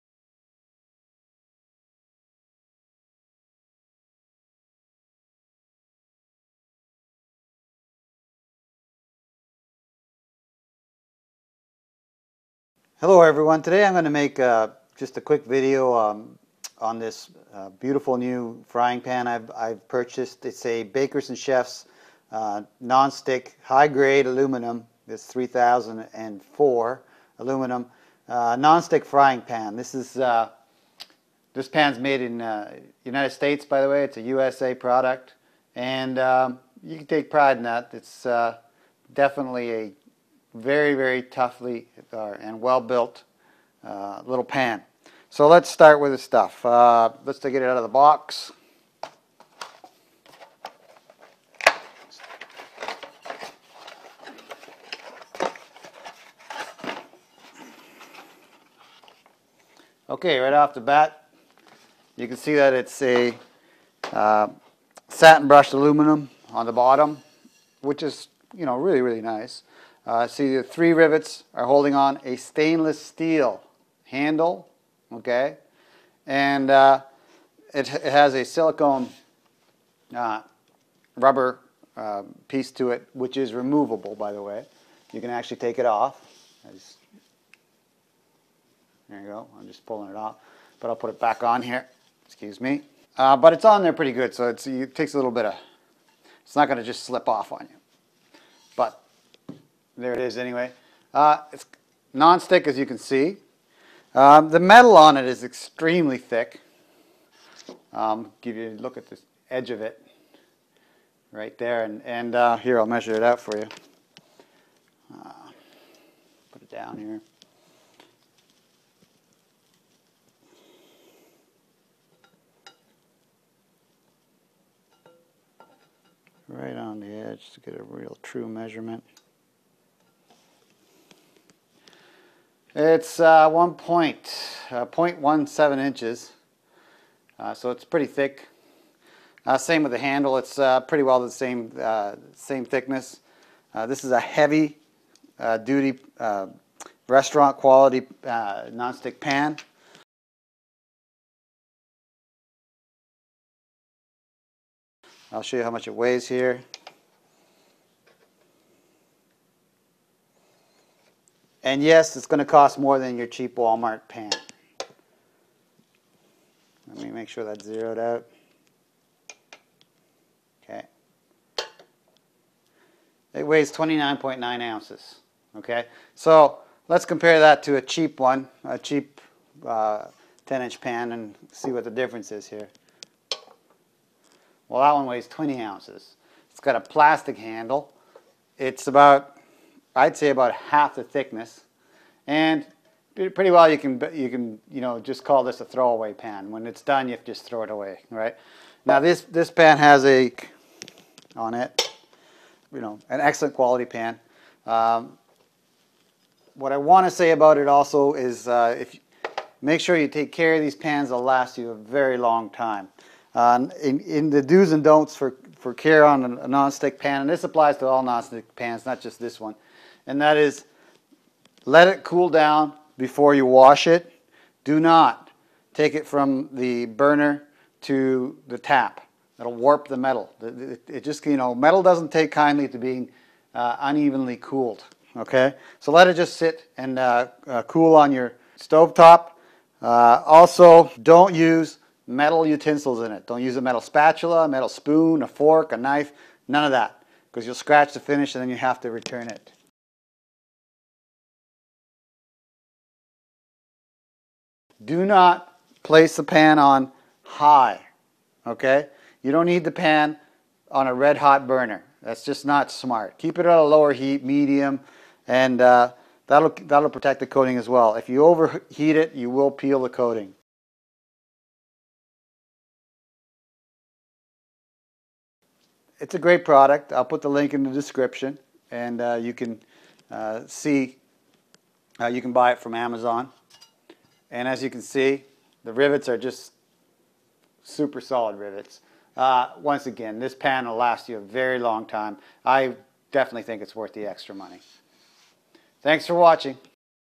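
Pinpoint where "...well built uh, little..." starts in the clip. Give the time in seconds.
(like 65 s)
42 s.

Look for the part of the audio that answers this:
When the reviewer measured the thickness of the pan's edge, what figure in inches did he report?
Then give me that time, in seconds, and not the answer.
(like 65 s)
134 s.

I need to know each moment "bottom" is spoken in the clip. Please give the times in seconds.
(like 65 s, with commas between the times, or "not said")
66 s.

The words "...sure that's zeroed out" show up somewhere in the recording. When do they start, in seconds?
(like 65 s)
167 s.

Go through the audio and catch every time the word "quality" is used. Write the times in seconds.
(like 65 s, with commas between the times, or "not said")
147 s, 203 s.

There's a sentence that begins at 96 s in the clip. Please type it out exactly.
It's not going to just slip off on you there it is anyway.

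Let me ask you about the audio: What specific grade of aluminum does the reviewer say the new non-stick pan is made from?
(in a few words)
3004.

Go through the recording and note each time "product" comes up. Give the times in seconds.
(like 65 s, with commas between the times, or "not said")
34 s, 276 s.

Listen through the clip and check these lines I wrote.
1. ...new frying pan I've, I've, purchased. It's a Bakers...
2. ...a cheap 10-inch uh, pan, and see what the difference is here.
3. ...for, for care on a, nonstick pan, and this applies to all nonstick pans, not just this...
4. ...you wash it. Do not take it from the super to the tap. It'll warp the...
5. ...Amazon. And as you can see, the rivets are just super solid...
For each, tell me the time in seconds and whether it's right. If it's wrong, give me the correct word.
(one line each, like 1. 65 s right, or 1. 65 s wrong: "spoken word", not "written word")
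1. 18 s right
2. 178 s right
3. 215 s right
4. 223 s wrong: "burner", not "super"
5. 282 s right.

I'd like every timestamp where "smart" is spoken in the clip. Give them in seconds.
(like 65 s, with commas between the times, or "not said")
262 s.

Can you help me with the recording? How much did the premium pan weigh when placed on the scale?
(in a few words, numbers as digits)
29.9 ounces.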